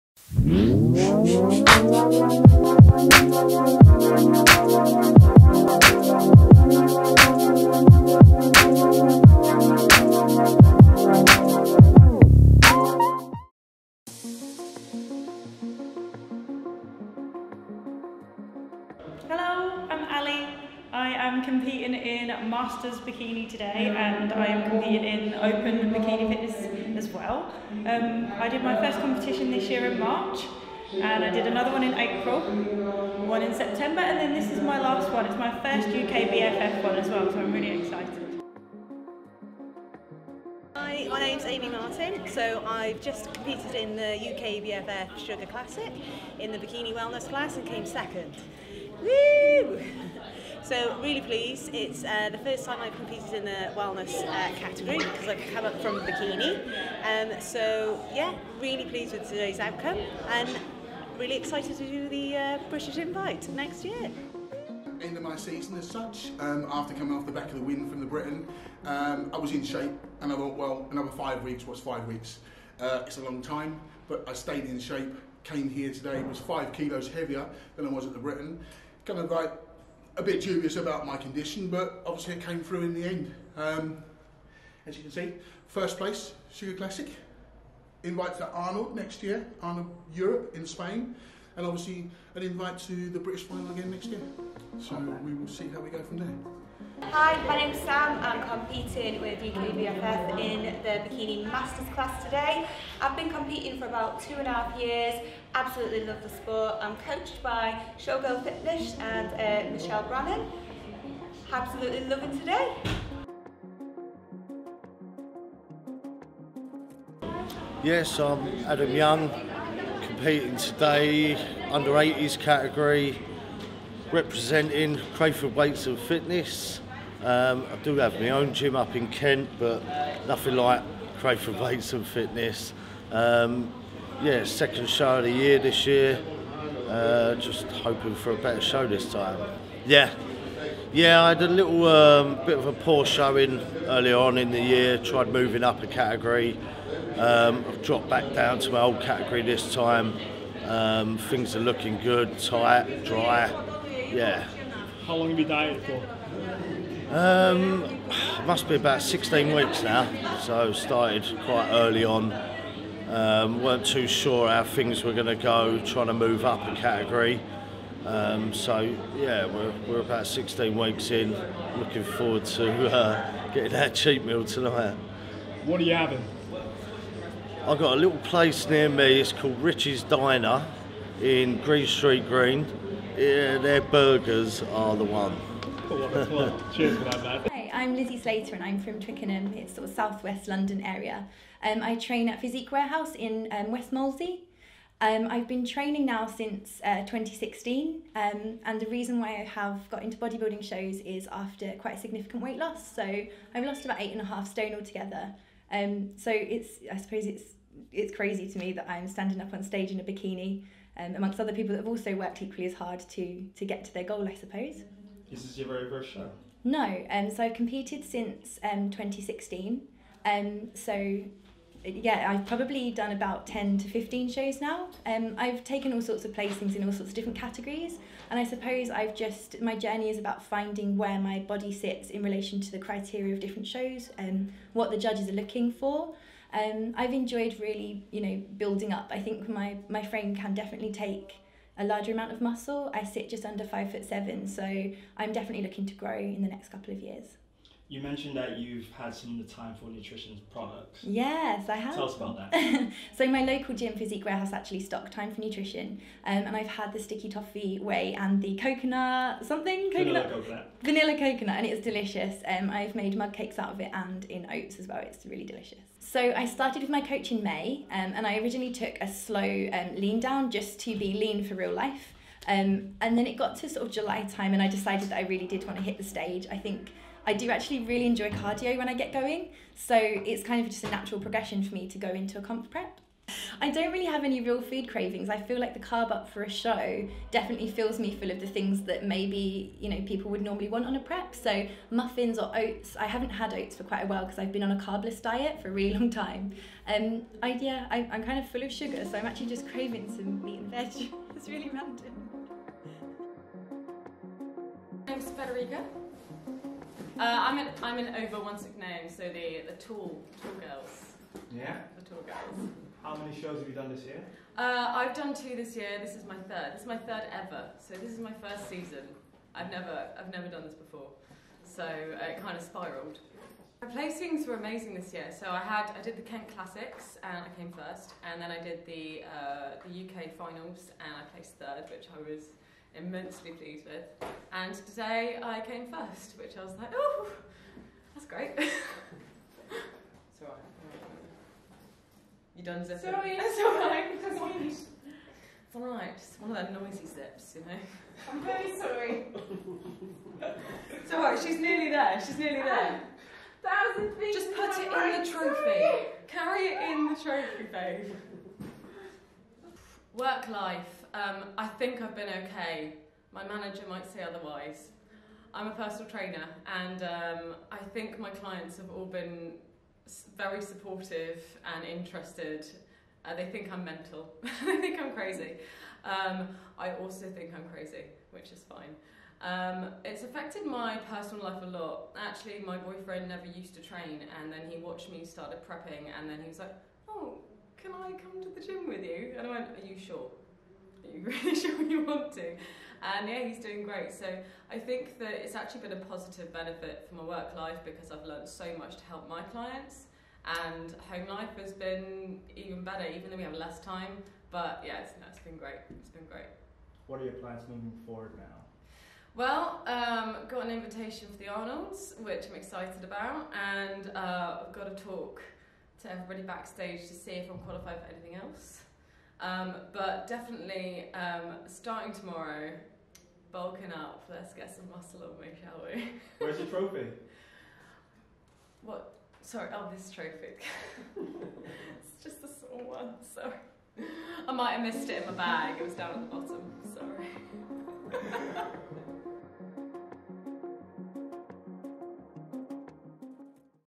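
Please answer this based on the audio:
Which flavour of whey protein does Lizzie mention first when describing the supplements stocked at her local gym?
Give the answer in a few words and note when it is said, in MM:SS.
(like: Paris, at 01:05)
Sticky toffee, at 04:16.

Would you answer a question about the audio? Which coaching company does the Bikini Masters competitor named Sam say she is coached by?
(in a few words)
Showgirl Fitness.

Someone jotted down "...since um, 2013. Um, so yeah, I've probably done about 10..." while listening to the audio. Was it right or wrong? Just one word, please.
wrong.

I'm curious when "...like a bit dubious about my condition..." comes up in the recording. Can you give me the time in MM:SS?
01:19.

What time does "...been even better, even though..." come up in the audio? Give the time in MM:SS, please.
06:41.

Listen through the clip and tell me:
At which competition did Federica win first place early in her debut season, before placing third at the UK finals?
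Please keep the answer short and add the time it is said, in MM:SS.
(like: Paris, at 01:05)
Kent Classics, at 05:26.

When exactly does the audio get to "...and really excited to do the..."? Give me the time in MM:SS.
01:00.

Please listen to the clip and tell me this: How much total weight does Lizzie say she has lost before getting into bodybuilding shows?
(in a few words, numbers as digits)
8.5 stone.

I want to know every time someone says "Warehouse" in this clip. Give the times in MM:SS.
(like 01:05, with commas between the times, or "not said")
03:12, 04:14.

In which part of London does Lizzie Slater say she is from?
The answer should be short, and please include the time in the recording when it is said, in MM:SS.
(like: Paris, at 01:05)
Twickenham, at 03:08.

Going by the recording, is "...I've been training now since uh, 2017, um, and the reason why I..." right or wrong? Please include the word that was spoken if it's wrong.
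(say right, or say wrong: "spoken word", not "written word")
wrong: "2016", not "2017".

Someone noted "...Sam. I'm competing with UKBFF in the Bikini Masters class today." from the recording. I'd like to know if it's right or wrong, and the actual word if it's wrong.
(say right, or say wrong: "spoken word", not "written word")
right.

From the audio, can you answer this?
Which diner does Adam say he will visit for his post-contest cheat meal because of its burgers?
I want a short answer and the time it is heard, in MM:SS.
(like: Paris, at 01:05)
Richie's Diner, at 02:59.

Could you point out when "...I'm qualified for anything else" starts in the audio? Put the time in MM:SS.
06:57.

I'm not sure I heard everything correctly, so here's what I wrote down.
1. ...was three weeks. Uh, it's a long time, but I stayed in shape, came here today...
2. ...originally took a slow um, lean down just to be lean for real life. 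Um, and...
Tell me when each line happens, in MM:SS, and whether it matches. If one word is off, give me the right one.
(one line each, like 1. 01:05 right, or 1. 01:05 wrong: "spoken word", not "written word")
1. 01:11 wrong: "five", not "three"
2. 04:28 right.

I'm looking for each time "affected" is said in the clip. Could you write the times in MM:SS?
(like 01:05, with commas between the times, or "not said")
06:20.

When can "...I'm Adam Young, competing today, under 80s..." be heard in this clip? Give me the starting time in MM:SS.
01:58.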